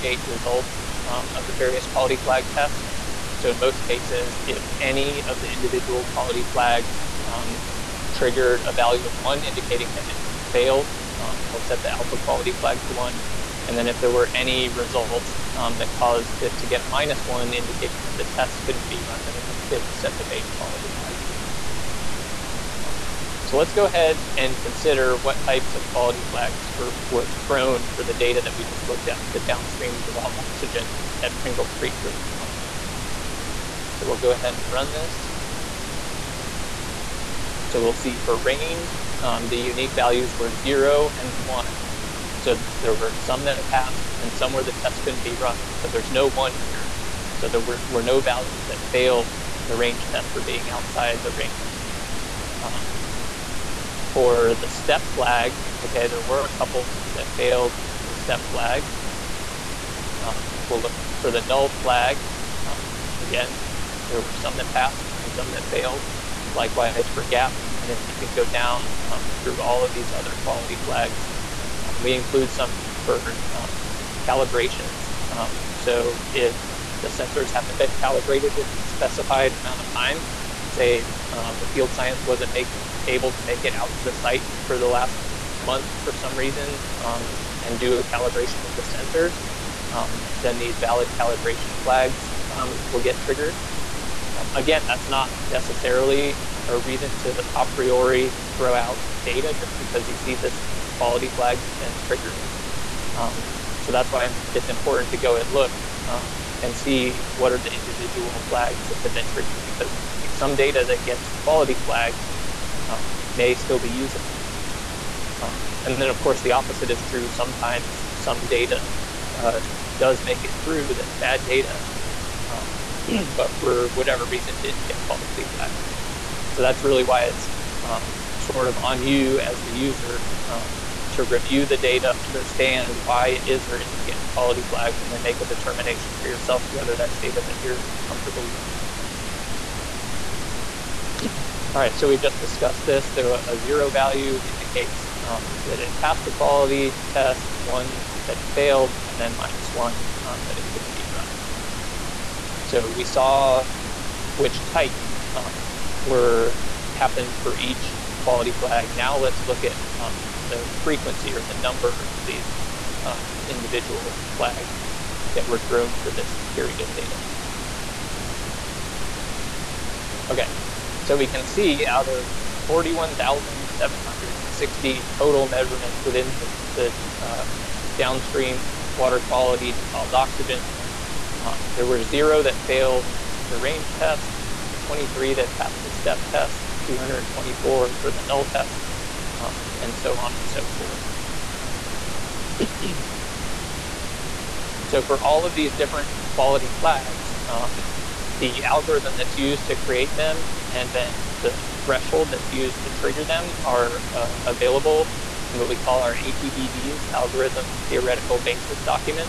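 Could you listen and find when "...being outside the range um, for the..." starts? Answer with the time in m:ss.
0:50.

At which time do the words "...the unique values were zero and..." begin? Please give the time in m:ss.
0:39.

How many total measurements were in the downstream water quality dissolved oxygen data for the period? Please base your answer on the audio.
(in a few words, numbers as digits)
41,760.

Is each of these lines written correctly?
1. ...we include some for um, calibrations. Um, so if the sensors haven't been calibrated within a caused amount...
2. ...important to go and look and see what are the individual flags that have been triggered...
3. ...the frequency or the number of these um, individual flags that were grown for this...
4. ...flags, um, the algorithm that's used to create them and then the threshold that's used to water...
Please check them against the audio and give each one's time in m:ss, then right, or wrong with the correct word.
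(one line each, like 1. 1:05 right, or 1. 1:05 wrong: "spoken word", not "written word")
1. 1:12 wrong: "specified", not "caused"
2. 1:44 right
3. 2:40 right
4. 3:16 wrong: "trigger", not "water".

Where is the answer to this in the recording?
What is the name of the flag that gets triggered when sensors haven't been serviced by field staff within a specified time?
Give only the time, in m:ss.
1:30.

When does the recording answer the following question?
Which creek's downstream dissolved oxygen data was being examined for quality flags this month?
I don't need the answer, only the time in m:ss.
0:31.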